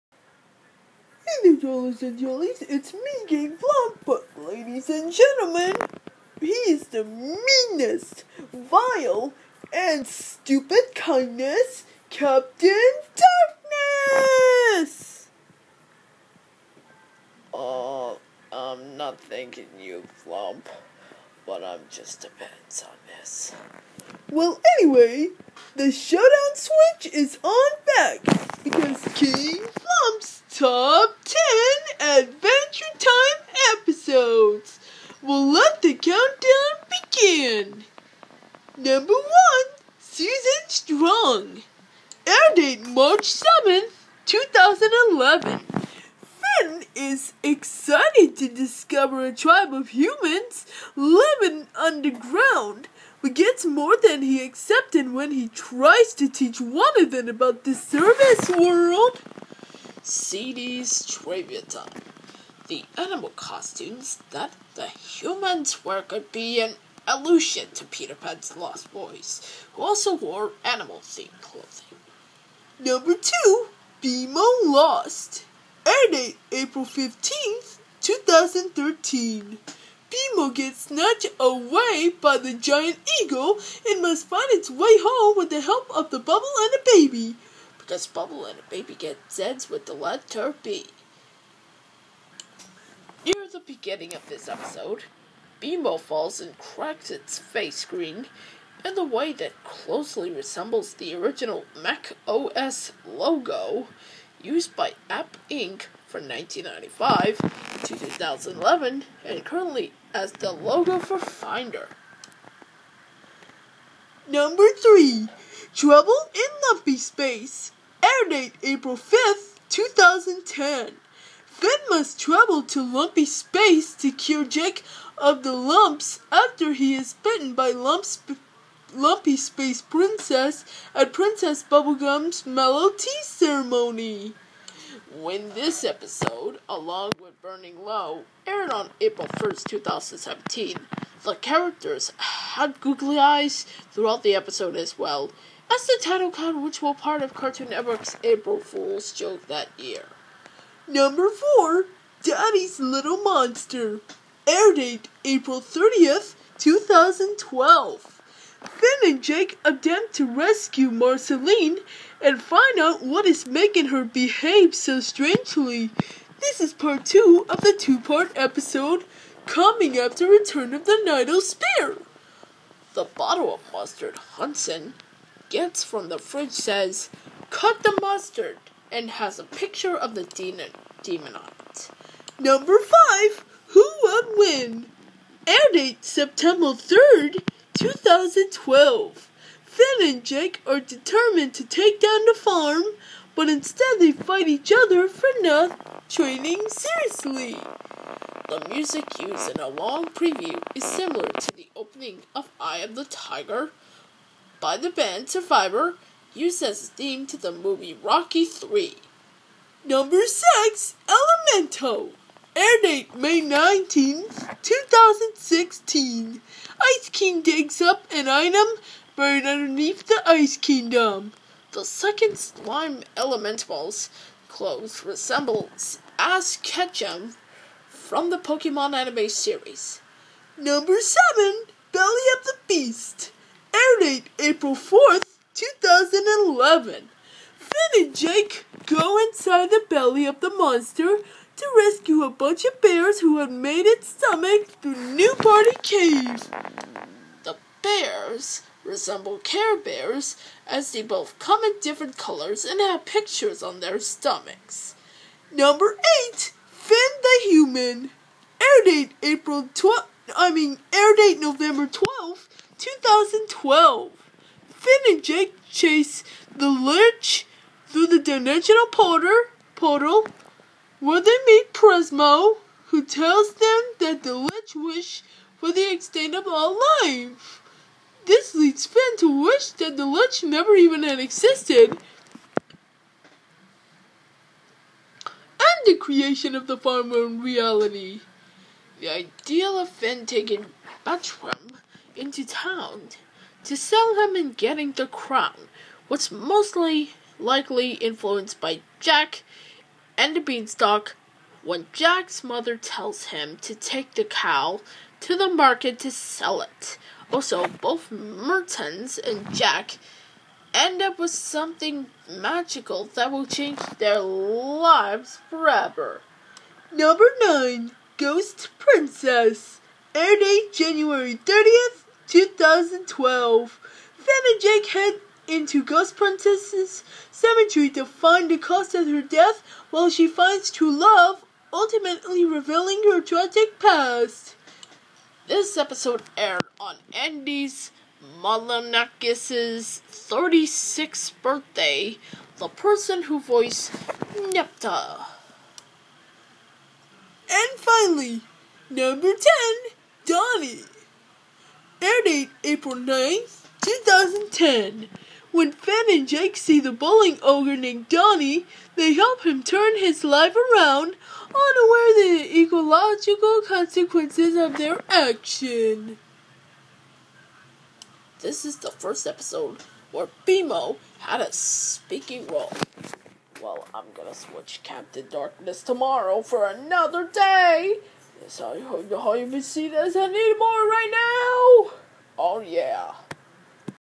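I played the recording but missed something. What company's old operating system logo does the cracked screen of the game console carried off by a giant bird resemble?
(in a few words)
Apple.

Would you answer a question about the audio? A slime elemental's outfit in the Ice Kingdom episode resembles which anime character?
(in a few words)
Ash Ketchum.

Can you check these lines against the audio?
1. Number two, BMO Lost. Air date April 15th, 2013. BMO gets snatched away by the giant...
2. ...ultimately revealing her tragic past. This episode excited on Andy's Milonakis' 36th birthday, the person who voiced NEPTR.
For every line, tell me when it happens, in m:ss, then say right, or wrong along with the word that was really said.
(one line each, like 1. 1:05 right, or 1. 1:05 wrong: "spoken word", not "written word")
1. 1:12 right
2. 5:31 wrong: "aired", not "excited".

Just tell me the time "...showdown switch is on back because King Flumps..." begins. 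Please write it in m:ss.
0:25.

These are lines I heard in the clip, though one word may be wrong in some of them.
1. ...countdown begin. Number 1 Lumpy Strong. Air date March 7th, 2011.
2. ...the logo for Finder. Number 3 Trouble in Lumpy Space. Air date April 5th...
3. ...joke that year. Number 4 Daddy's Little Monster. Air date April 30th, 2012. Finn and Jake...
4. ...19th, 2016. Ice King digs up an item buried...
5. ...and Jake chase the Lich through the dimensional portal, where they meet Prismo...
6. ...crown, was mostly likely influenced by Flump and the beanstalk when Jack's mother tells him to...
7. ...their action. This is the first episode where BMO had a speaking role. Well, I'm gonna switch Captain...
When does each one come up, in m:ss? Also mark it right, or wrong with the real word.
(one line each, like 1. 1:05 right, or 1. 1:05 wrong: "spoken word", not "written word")
1. 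0:35 wrong: "Susan", not "Lumpy"
2. 1:50 right
3. 2:29 right
4. 3:33 right
5. 4:25 right
6. 4:55 wrong: "Jack", not "Flump"
7. 6:04 right.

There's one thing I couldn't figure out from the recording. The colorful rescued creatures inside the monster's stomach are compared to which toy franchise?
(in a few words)
Care Bears.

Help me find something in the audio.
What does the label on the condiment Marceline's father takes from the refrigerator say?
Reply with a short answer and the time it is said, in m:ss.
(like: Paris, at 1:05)
Cut the mustard, at 2:57.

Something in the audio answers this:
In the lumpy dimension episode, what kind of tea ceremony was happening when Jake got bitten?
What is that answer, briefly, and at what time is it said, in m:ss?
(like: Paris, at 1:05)
Mallow Tea, at 2:12.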